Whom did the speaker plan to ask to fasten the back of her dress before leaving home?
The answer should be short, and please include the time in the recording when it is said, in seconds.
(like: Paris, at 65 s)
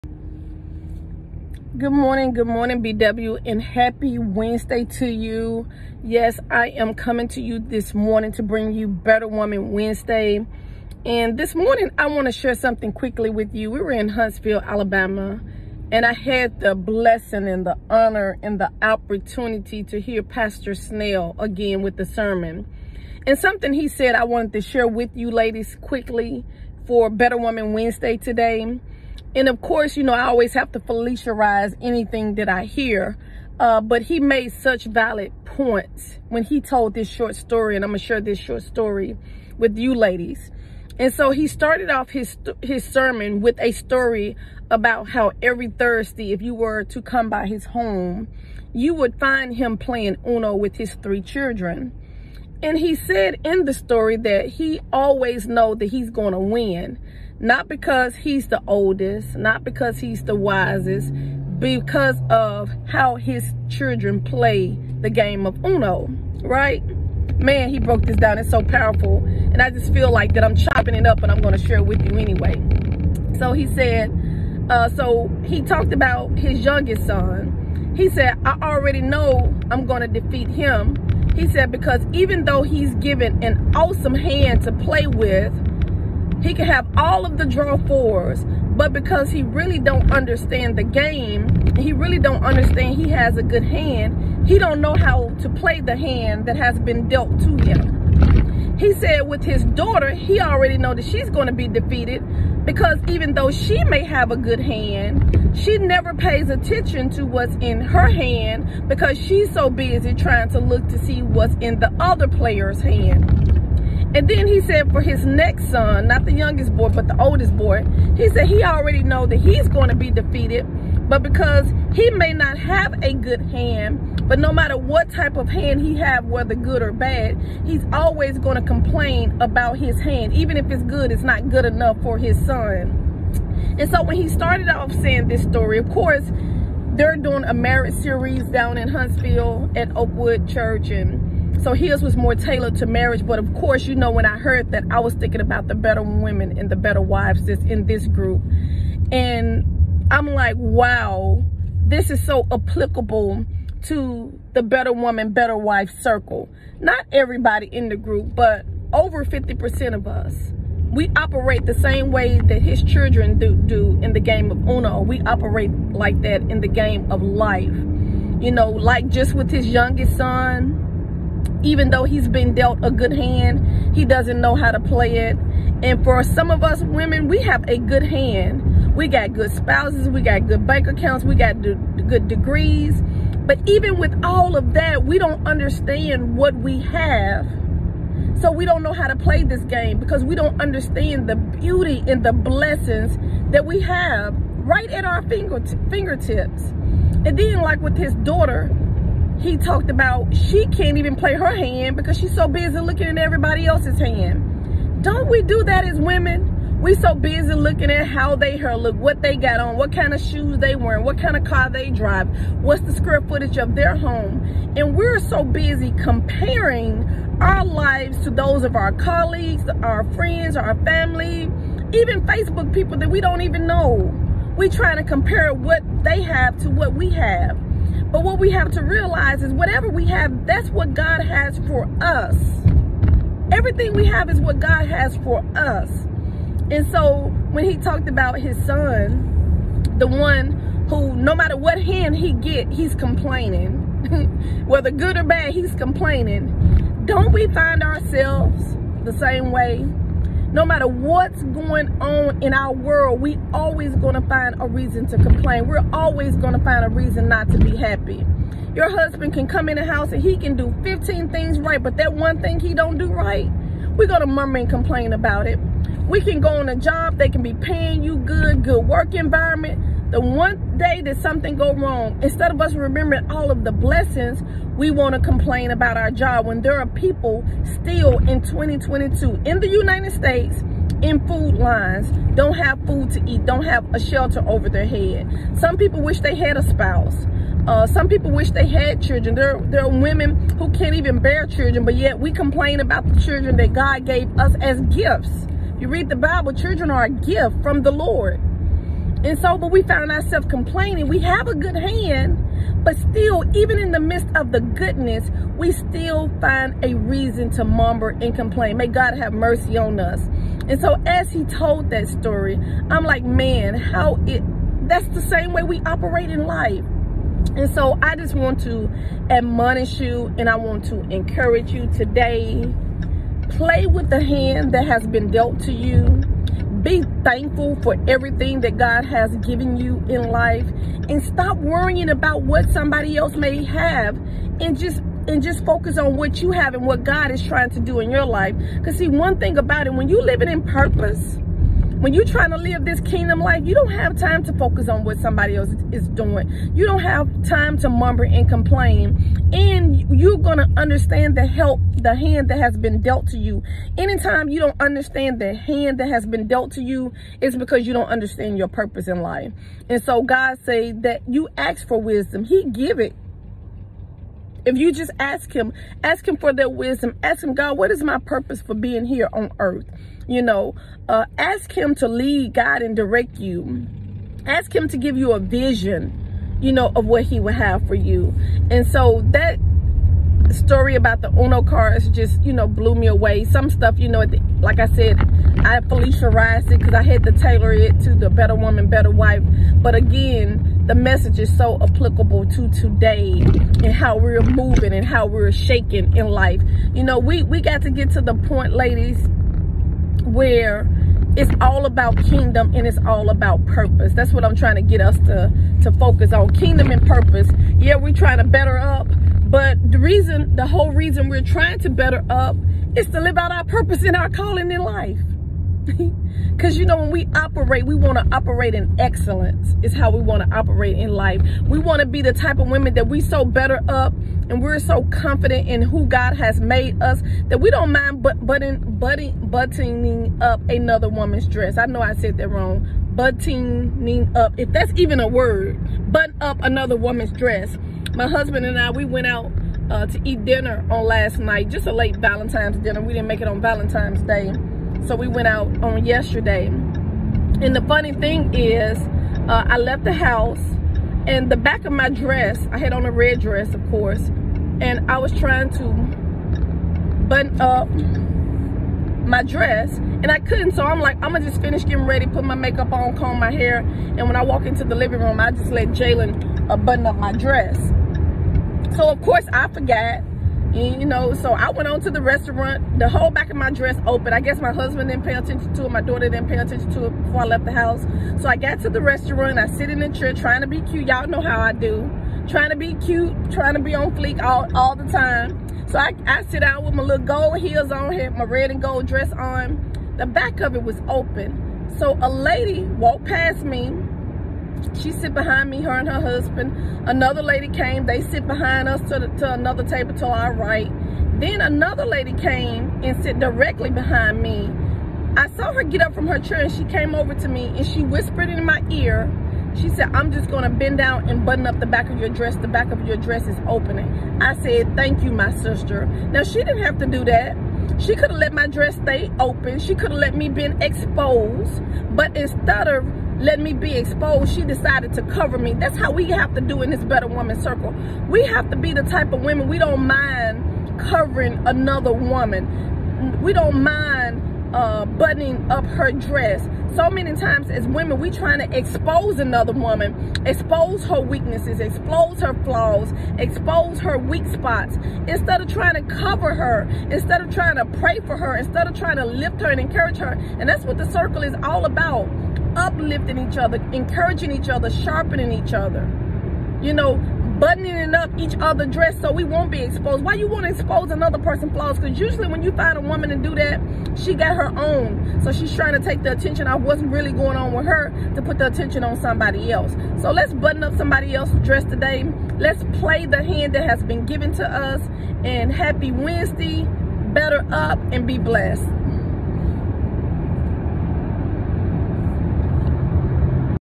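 Jalen, at 465 s.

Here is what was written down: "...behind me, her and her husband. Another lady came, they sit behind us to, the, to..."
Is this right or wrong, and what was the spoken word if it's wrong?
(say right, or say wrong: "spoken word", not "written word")
right.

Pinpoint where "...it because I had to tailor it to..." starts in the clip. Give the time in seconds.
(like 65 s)
386 s.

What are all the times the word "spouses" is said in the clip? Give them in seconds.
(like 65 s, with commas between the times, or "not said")
179 s, 286 s.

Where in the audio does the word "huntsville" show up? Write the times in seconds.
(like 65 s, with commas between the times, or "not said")
14 s, 138 s.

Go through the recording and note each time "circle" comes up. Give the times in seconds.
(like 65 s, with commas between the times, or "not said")
156 s, 527 s, 551 s.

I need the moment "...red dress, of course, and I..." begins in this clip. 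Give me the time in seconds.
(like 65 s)
453 s.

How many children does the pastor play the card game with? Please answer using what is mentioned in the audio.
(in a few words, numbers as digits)
3.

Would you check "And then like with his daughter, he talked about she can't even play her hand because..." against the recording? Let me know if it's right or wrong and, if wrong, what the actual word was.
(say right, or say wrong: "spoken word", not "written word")
right.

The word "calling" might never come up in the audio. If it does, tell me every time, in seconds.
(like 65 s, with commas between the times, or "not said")
414 s.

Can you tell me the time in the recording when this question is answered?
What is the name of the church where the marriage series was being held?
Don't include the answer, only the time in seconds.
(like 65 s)
139 s.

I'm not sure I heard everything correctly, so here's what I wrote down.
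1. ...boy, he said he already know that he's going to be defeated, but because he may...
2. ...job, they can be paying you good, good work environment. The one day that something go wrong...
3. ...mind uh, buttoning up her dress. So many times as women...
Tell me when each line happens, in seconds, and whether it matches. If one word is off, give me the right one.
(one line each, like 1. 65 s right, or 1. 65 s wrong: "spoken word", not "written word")
1. 117 s right
2. 266 s right
3. 533 s right.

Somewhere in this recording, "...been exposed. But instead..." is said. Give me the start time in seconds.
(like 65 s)
520 s.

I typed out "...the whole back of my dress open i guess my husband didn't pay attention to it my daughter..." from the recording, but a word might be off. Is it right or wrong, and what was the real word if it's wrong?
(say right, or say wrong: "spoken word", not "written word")
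right.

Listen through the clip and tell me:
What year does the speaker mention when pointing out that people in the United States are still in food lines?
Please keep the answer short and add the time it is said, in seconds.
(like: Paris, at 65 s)
2022, at 278 s.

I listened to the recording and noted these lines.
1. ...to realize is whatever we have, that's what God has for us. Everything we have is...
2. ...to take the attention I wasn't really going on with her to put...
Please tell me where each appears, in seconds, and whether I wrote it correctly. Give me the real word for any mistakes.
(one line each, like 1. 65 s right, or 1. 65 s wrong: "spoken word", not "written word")
1. 228 s right
2. 565 s right.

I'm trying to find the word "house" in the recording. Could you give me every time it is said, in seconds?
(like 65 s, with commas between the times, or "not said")
259 s, 450 s, 477 s.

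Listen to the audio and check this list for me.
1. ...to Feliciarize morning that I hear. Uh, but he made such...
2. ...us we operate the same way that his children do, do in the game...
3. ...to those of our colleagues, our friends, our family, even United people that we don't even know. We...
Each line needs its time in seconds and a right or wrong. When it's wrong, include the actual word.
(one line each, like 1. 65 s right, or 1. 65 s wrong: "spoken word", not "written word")
1. 30 s wrong: "anything", not "morning"
2. 160 s right
3. 218 s wrong: "Facebook", not "United".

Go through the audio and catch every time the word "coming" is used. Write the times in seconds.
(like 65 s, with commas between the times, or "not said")
6 s.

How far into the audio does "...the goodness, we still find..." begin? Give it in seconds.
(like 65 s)
304 s.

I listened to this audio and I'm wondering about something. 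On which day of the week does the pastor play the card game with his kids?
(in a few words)
Thursday.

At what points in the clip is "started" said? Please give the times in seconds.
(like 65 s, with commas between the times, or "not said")
41 s, 134 s.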